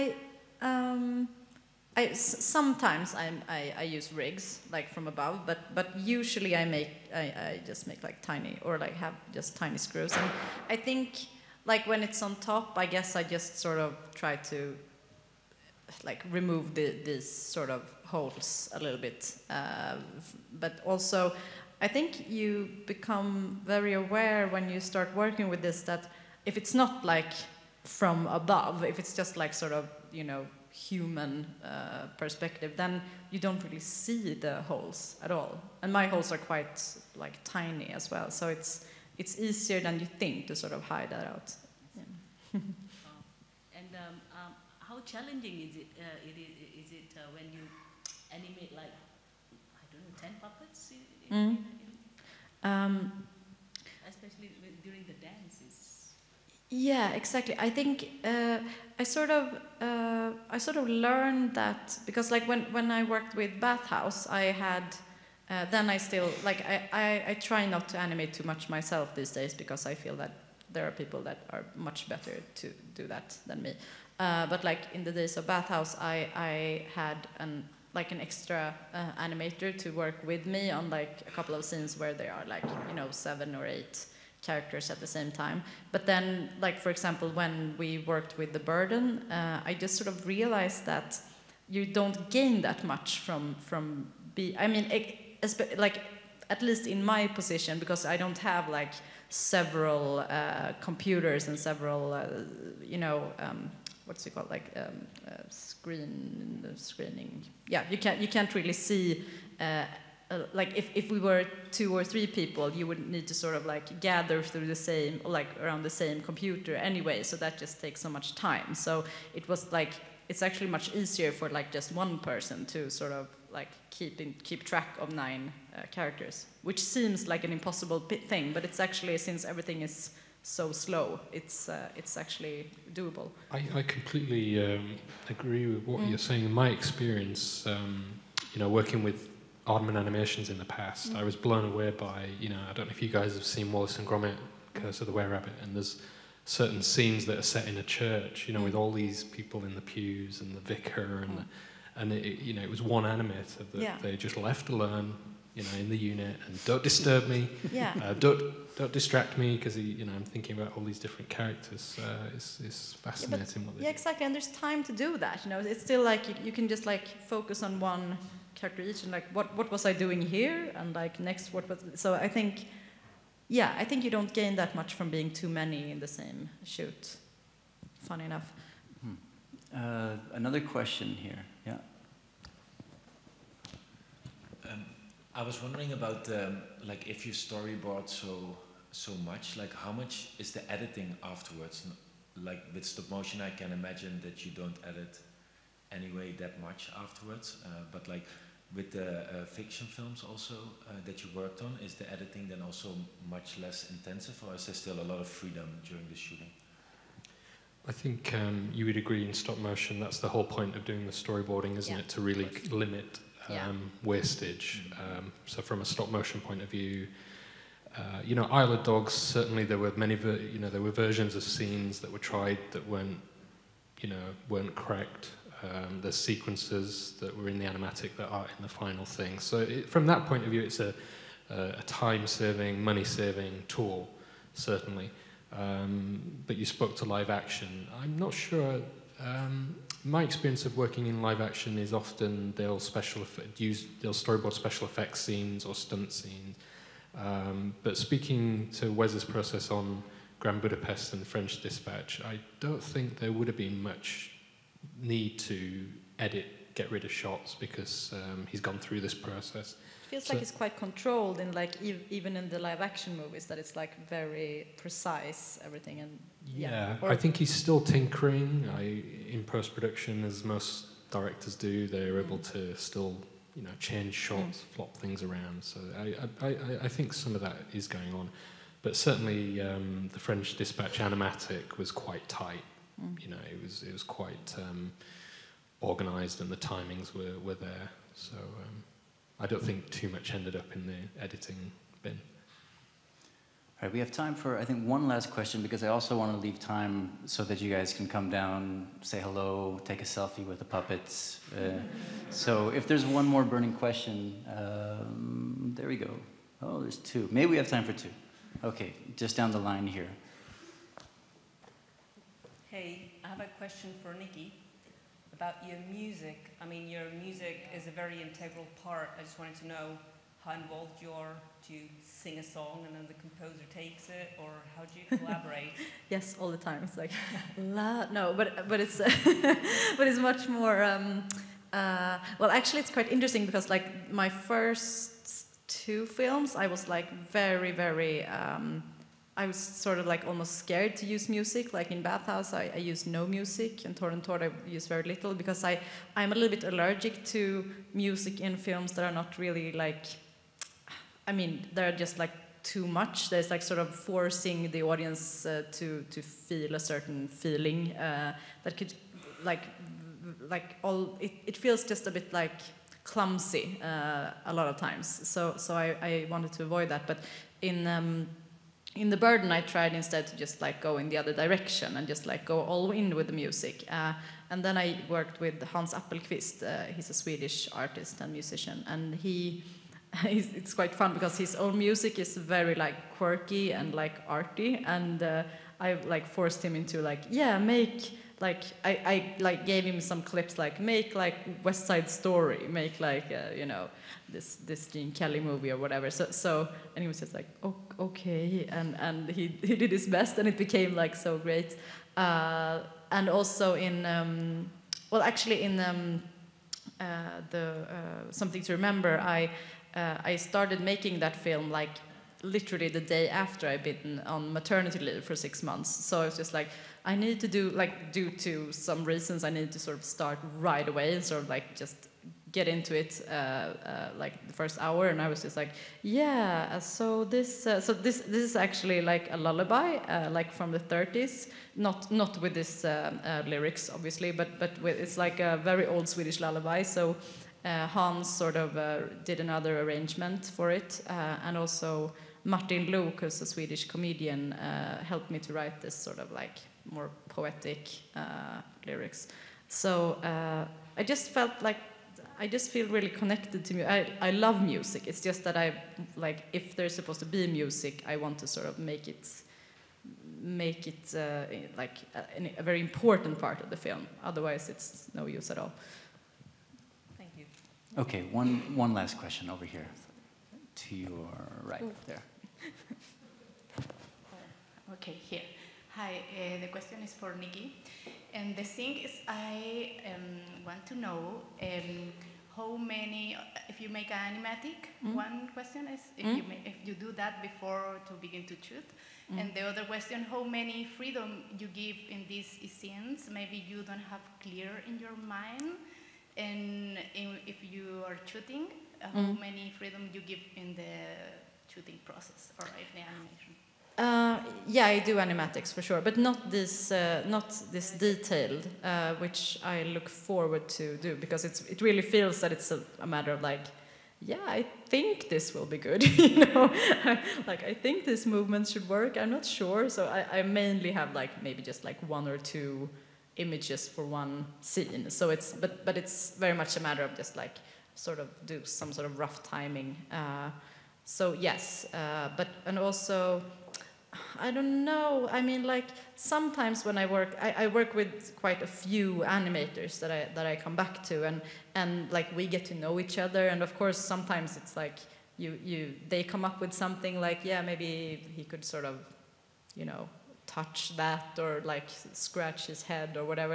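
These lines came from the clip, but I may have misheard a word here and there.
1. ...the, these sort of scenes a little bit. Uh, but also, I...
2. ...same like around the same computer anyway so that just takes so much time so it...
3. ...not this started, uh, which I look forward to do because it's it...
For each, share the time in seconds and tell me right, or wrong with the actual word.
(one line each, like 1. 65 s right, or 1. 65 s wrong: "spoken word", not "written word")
1. 16 s wrong: "holes", not "scenes"
2. 114 s right
3. 507 s wrong: "detailed", not "started".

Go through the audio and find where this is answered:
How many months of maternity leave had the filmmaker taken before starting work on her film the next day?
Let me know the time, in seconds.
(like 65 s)
415 s.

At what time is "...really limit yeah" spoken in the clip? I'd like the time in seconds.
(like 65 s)
212 s.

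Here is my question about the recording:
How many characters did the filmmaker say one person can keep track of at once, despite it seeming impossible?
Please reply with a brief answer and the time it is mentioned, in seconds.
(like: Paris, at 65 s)
9, at 125 s.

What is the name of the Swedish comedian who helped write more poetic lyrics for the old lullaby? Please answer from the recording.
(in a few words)
Martin Luuk.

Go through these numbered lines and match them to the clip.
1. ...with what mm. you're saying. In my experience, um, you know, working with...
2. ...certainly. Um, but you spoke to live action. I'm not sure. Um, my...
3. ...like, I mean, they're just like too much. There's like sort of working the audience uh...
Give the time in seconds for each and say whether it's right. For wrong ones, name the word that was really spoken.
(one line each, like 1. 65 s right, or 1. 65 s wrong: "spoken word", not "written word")
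1. 135 s right
2. 234 s right
3. 349 s wrong: "forcing", not "working".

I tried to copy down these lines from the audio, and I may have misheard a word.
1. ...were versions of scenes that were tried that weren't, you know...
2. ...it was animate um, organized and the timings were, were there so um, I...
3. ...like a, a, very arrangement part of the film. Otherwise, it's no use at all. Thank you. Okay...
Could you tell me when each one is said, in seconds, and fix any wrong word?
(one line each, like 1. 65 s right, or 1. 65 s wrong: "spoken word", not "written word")
1. 220 s right
2. 283 s wrong: "quite", not "animate"
3. 461 s wrong: "important", not "arrangement".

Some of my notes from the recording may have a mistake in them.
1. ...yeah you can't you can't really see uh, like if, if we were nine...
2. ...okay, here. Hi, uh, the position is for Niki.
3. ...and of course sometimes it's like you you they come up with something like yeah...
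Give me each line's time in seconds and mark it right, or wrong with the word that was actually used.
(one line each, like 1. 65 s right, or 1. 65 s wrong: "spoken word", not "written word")
1. 107 s wrong: "two", not "nine"
2. 474 s wrong: "question", not "position"
3. 543 s right.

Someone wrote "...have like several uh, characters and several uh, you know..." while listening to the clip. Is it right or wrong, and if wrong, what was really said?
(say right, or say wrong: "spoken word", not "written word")
wrong: "computers", not "characters".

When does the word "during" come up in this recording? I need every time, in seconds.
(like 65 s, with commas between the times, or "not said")
54 s, 205 s.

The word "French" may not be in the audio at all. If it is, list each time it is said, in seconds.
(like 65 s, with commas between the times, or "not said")
251 s, 280 s.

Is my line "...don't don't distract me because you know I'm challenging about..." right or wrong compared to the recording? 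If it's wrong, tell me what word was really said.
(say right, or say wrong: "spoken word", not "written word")
wrong: "thinking", not "challenging".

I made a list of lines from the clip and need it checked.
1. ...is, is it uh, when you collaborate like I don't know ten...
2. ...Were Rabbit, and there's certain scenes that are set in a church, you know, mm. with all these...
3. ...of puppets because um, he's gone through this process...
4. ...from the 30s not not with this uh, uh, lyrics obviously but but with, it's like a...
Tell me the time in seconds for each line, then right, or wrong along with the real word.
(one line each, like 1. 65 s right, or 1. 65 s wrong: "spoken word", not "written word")
1. 46 s wrong: "animate", not "collaborate"
2. 145 s right
3. 257 s wrong: "shots", not "puppets"
4. 430 s right.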